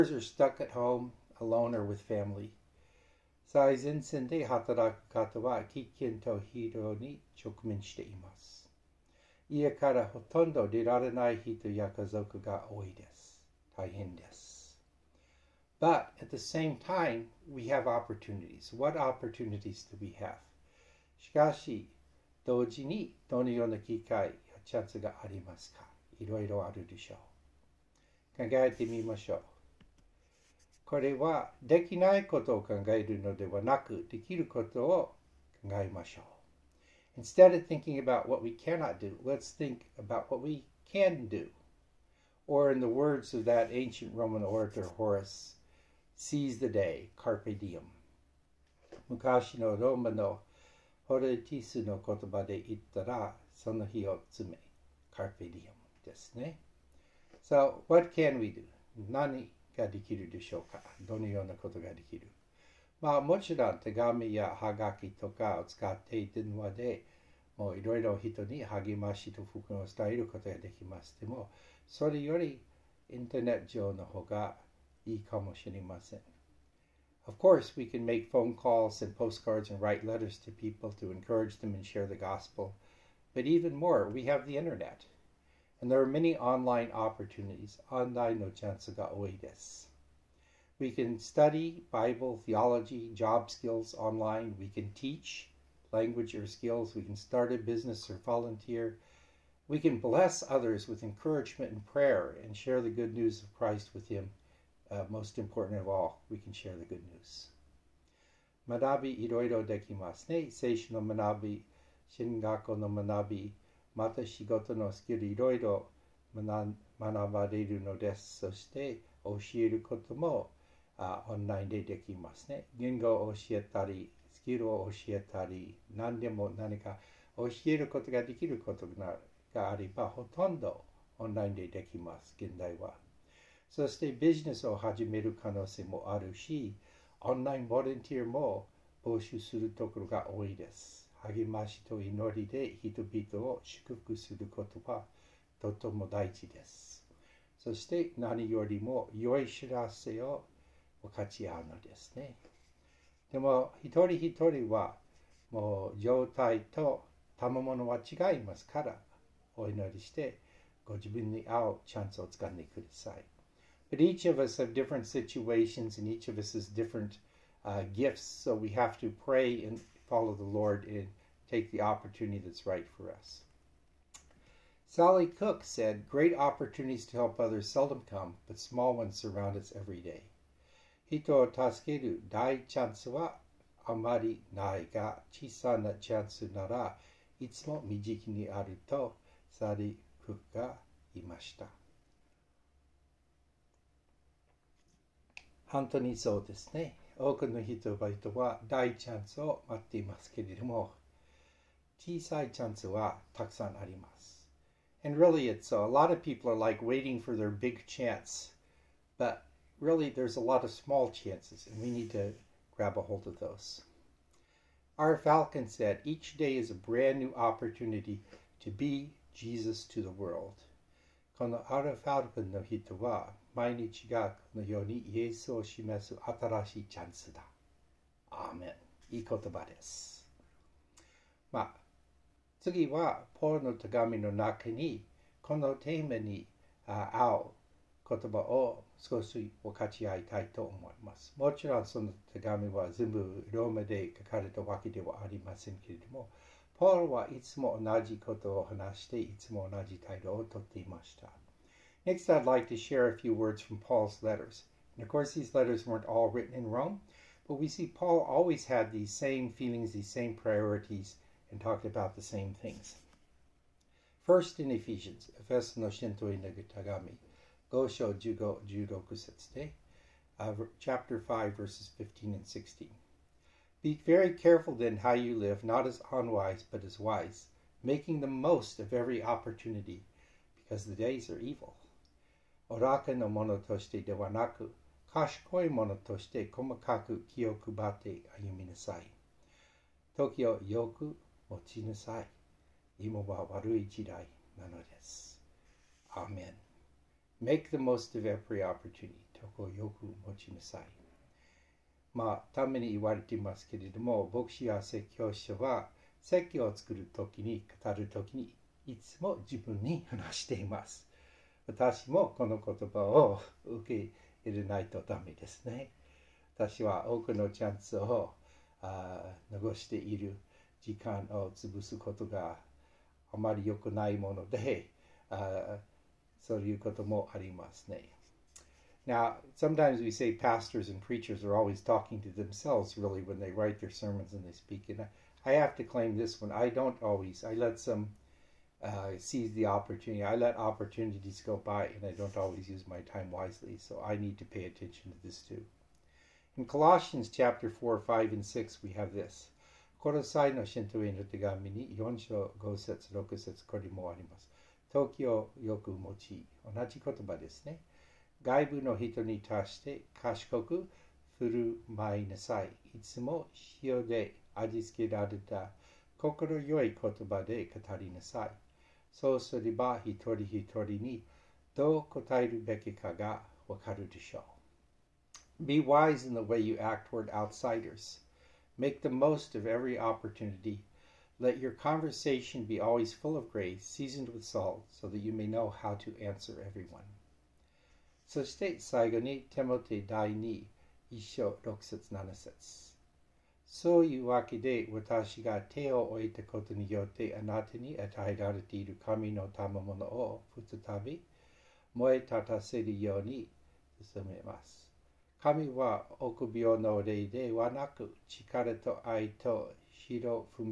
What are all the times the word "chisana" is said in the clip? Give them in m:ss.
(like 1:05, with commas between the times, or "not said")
3:05.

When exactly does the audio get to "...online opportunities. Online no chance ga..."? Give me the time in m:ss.
1:26.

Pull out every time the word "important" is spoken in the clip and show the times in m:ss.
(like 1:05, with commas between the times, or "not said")
1:45.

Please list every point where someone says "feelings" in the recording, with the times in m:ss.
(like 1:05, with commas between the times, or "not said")
4:19.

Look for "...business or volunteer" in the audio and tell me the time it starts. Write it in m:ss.
1:37.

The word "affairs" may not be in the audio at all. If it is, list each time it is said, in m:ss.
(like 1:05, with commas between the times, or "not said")
not said.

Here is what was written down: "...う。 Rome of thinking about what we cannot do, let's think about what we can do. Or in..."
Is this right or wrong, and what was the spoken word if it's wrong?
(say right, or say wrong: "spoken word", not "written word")
wrong: "Instead", not "Rome".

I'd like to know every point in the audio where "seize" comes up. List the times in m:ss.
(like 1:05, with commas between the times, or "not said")
0:46, 5:39.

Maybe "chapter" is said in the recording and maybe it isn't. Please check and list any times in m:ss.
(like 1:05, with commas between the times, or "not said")
4:30, 5:47.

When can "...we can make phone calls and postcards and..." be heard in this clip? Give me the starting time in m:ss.
1:17.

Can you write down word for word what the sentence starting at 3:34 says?
Our Falcon said each day is a brand new opportunity to be Jesus to the world.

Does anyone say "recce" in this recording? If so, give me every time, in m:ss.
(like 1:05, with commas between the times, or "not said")
not said.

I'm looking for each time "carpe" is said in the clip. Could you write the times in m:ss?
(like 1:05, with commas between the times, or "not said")
0:47, 0:55.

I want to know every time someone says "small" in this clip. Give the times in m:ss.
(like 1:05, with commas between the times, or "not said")
2:58, 3:30.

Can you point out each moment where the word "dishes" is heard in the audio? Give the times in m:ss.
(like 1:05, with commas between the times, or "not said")
not said.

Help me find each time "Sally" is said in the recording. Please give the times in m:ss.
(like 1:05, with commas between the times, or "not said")
2:54, 3:09.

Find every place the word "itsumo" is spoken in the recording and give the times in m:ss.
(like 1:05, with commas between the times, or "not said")
3:07.